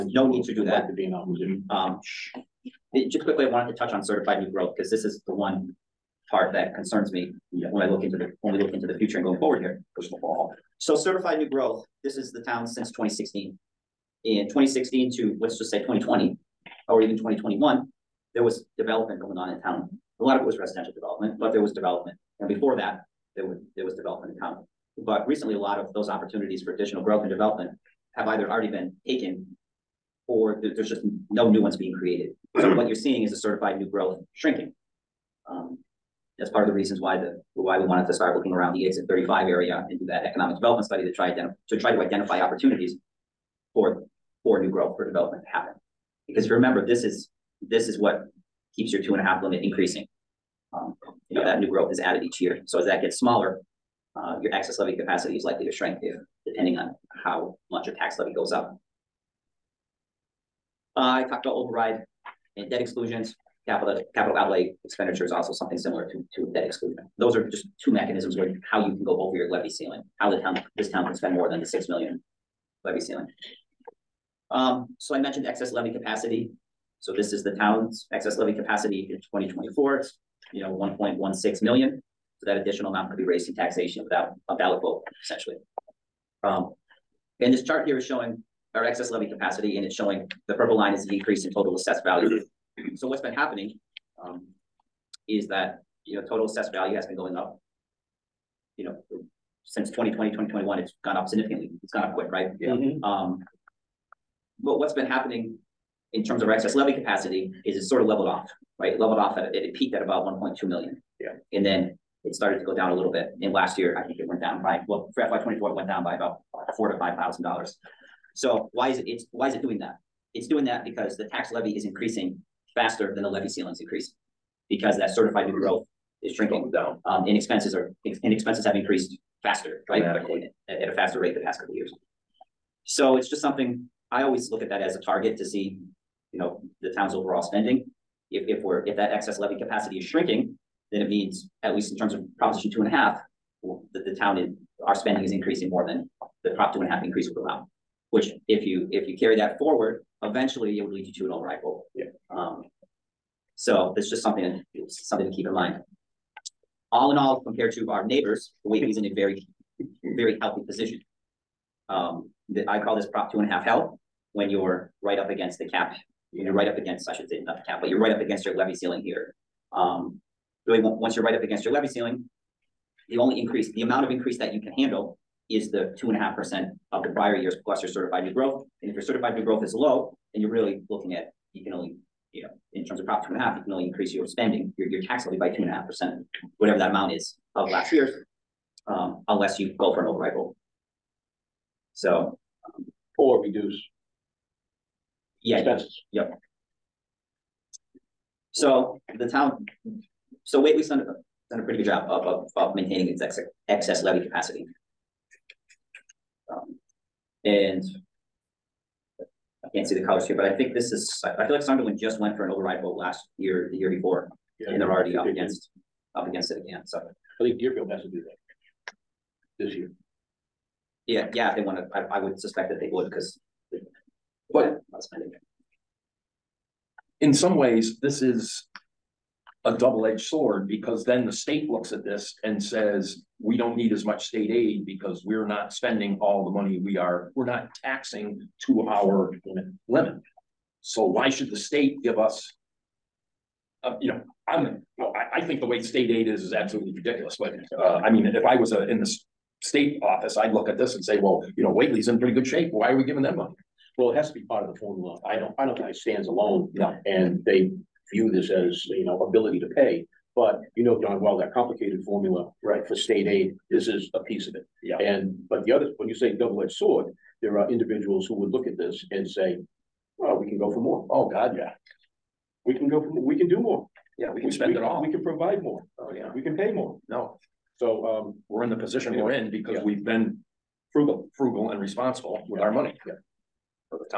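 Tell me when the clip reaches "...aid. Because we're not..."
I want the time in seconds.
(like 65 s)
234 s.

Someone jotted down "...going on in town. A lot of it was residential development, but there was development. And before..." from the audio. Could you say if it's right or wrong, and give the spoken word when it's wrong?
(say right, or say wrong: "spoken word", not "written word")
right.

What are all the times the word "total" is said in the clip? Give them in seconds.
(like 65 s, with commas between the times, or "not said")
91 s, 96 s.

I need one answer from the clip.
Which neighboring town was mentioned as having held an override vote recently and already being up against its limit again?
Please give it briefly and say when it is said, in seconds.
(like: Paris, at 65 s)
Sunderland, at 211 s.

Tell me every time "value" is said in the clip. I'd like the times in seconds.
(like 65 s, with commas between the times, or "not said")
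92 s, 96 s.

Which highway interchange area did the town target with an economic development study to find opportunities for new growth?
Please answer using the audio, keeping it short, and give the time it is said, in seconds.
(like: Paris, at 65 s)
Exit 35, at 38 s.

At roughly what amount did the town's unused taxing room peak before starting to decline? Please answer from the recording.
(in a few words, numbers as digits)
1.2 million.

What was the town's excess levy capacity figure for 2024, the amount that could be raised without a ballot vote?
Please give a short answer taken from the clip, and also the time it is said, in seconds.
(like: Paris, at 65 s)
1.16 million, at 80 s.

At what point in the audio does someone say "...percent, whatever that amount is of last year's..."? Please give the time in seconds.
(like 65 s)
185 s.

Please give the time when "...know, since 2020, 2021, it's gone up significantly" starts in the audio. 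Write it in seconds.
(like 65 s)
98 s.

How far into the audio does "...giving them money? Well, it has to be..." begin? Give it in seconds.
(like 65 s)
253 s.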